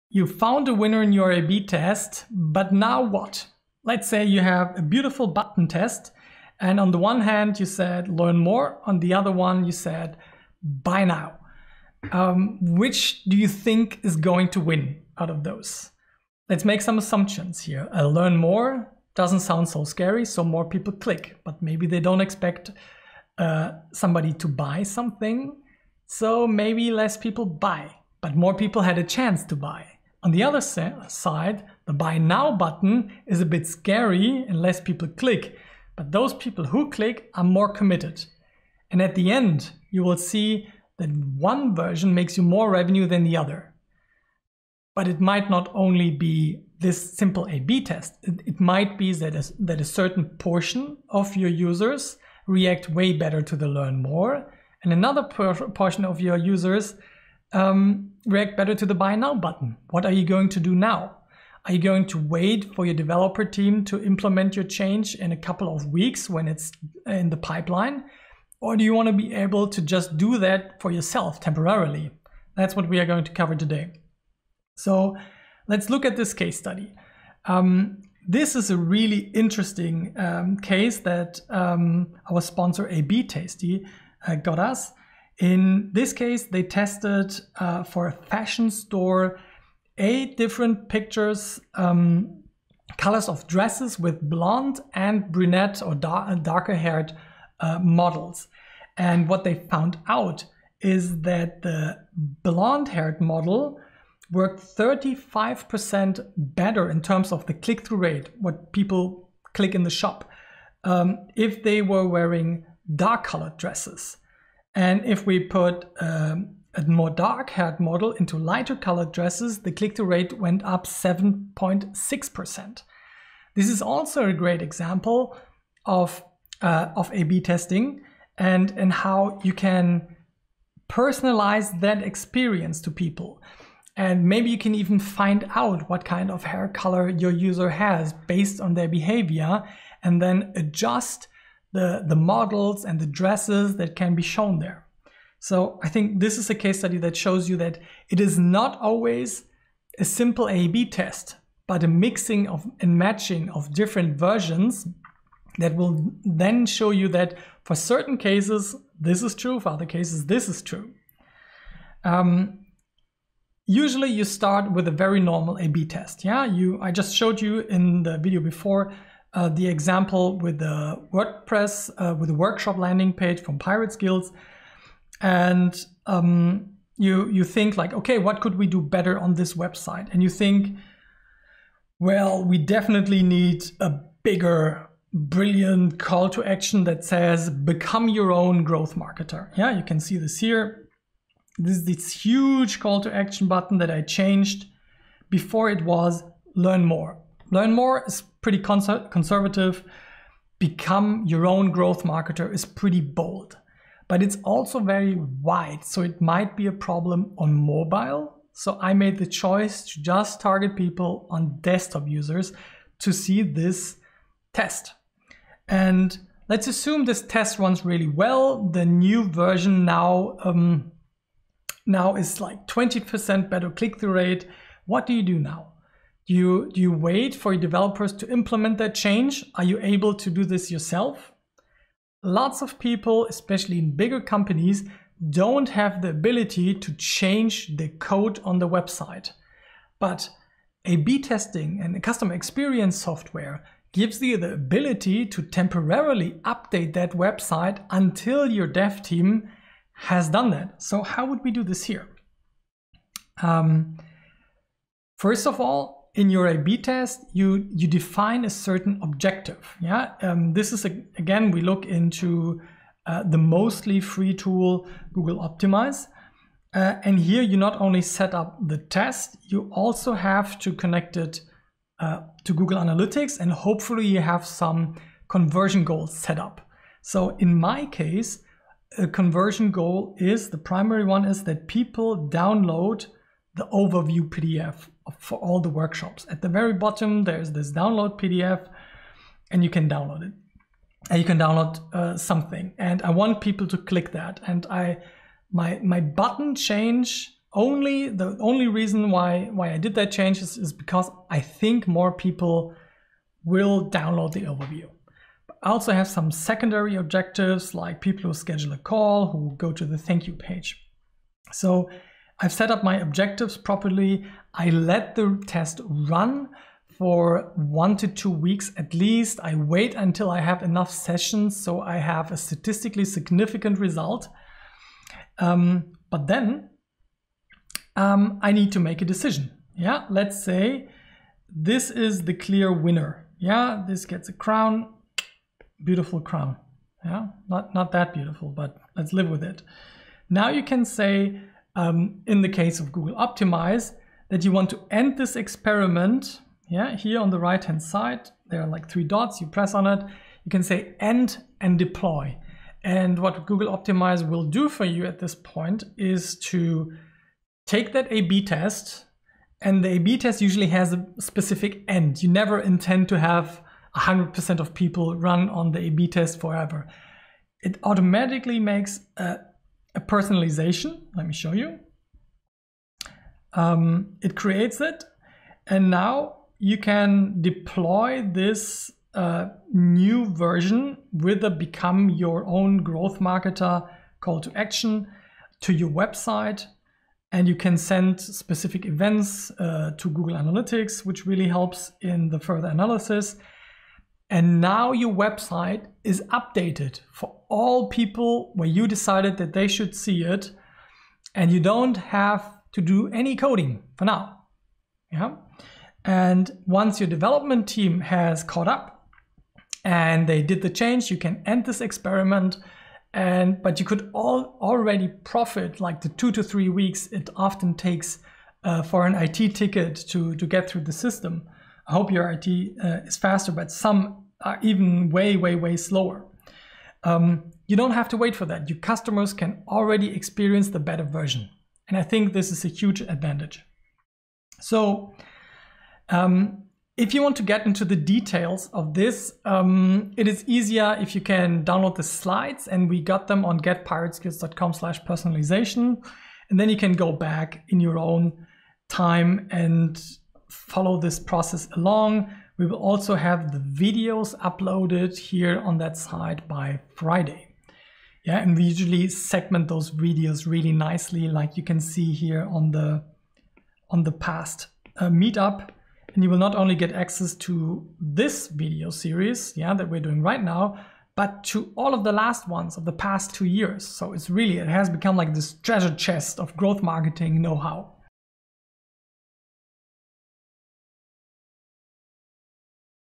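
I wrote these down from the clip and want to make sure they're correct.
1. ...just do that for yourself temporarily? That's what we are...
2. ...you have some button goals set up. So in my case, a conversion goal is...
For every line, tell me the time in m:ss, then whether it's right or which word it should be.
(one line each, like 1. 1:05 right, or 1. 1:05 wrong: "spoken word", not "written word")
1. 1:09 right
2. 4:34 wrong: "conversion", not "button".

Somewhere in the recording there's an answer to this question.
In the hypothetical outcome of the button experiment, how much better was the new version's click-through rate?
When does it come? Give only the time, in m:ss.
3:42.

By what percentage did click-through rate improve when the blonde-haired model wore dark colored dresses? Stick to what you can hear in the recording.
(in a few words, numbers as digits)
35%.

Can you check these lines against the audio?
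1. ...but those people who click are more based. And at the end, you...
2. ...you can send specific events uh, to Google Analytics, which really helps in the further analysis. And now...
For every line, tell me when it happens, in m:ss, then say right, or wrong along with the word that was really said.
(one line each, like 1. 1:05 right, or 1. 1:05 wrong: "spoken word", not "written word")
1. 0:35 wrong: "committed", not "based"
2. 6:27 right.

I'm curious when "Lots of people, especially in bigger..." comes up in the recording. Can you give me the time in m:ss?
3:52.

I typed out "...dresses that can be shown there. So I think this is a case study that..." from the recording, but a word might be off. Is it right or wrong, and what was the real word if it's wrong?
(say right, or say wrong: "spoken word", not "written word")
right.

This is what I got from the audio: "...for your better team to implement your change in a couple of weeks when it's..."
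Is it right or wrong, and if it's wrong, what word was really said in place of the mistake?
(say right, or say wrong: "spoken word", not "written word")
wrong: "developer", not "better".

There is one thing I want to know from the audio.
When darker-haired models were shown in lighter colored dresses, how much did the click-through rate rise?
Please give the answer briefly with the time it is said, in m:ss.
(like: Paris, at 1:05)
7.6%, at 2:00.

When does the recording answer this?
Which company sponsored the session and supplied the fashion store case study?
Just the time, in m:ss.
1:22.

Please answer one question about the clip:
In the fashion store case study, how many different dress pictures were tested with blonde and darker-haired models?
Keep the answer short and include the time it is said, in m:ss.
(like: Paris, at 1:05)
8, at 1:29.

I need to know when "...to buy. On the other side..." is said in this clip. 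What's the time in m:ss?
0:29.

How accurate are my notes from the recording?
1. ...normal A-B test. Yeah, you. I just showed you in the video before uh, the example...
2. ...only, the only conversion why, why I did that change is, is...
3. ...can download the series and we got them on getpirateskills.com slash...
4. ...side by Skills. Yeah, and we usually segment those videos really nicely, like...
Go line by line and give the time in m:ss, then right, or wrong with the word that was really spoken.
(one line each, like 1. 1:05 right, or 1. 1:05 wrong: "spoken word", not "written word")
1. 2:45 right
2. 4:57 wrong: "reason", not "conversion"
3. 7:21 wrong: "slides", not "series"
4. 7:35 wrong: "Friday", not "Skills".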